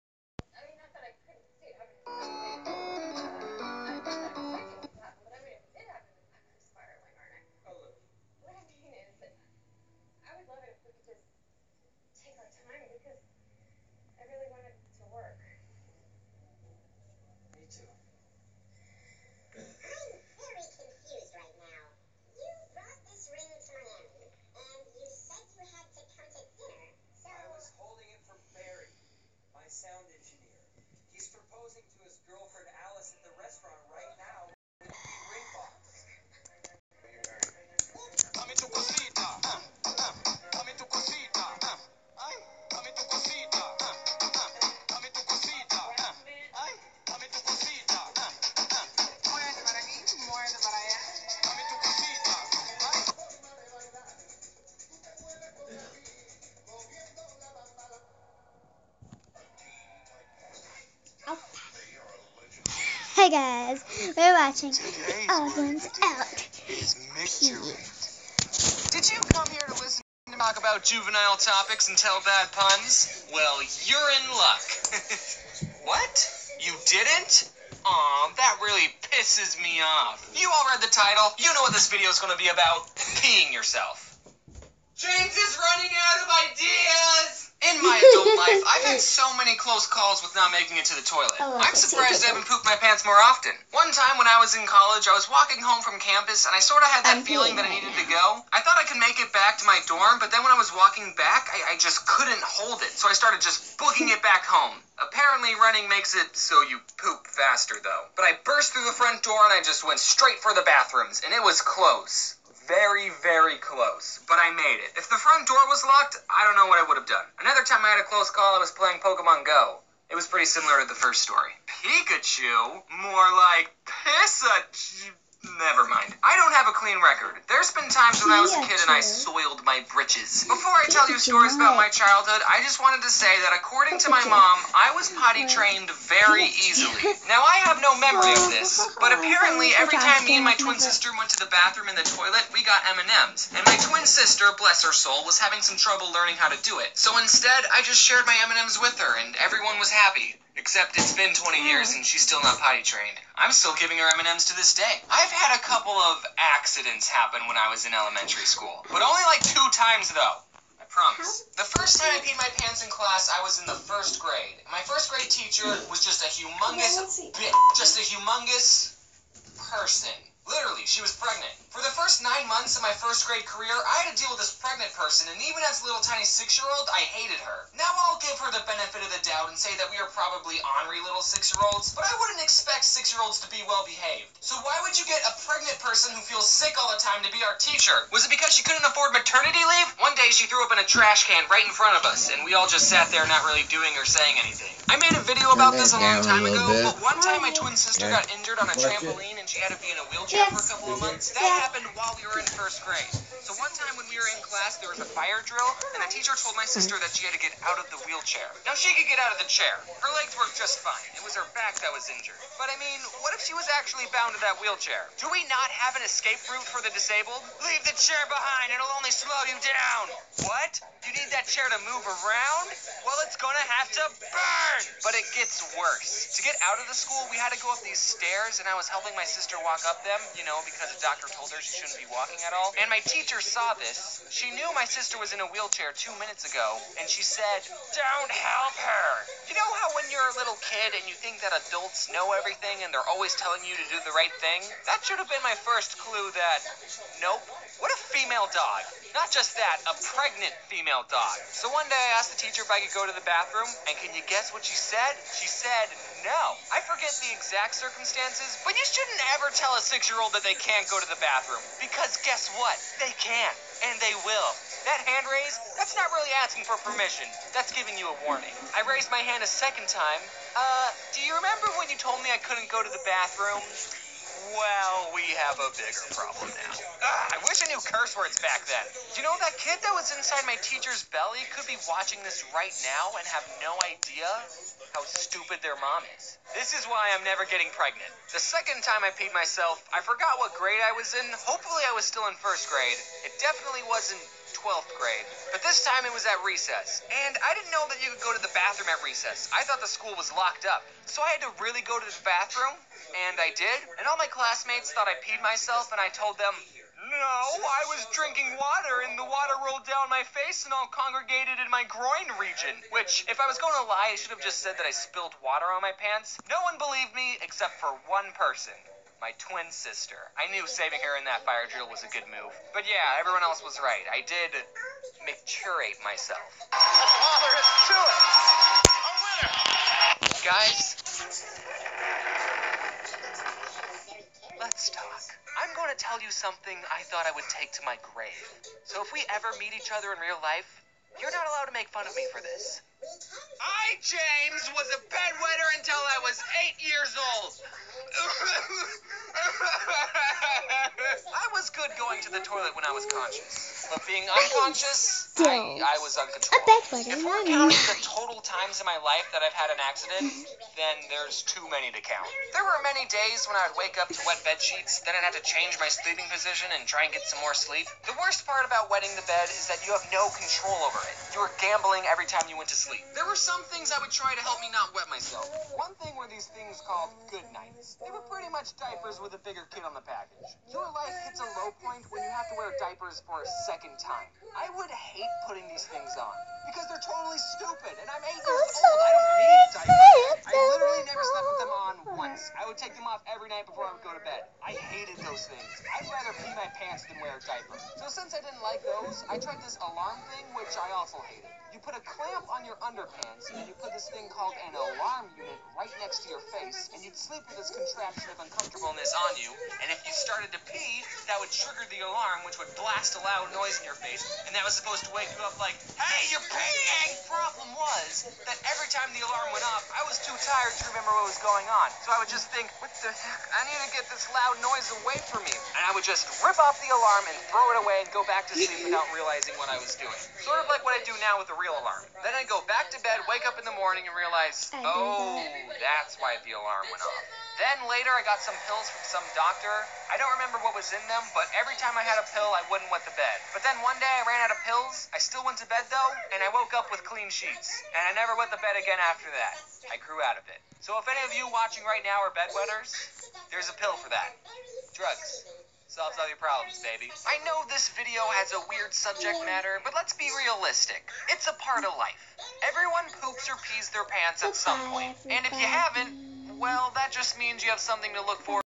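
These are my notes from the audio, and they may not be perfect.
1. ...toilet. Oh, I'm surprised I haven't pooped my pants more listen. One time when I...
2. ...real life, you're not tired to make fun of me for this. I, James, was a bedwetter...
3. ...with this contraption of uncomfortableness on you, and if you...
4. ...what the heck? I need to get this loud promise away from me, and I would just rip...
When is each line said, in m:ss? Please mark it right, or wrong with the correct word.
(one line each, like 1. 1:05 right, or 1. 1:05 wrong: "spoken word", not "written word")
1. 1:31 wrong: "often", not "listen"
2. 5:40 wrong: "allowed", not "tired"
3. 6:47 right
4. 7:02 wrong: "noise", not "promise".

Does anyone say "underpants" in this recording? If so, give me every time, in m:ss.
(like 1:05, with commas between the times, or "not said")
6:42.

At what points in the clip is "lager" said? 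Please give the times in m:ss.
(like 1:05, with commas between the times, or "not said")
not said.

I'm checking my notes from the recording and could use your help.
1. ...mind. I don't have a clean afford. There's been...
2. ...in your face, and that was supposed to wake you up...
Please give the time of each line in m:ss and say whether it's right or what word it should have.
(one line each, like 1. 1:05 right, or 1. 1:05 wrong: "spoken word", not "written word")
1. 2:05 wrong: "record", not "afford"
2. 6:53 right.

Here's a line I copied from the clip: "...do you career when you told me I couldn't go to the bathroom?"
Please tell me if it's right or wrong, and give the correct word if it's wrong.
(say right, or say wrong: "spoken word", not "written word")
wrong: "remember", not "career".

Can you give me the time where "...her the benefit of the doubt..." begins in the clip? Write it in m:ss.
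2:58.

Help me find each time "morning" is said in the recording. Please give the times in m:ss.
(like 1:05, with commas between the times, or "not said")
7:13.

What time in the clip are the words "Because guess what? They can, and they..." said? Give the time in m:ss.
4:21.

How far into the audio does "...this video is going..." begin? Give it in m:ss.
1:21.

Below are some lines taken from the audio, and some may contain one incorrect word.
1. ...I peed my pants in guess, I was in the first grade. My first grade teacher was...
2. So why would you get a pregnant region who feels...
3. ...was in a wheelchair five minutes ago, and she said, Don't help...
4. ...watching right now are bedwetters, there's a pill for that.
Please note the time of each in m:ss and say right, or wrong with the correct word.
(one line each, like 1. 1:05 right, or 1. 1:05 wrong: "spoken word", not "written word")
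1. 2:42 wrong: "class", not "guess"
2. 3:04 wrong: "person", not "region"
3. 3:55 wrong: "two", not "five"
4. 7:31 right.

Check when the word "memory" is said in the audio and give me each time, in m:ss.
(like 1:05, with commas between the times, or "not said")
2:17.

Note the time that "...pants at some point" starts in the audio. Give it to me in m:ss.
7:44.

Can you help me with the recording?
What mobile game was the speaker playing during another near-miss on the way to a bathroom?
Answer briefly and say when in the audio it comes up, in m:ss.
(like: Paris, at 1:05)
Pokemon Go, at 1:58.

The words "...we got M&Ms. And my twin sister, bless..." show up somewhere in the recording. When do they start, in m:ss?
2:22.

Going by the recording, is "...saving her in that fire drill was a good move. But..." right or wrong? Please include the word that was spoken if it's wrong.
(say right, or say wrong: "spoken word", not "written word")
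right.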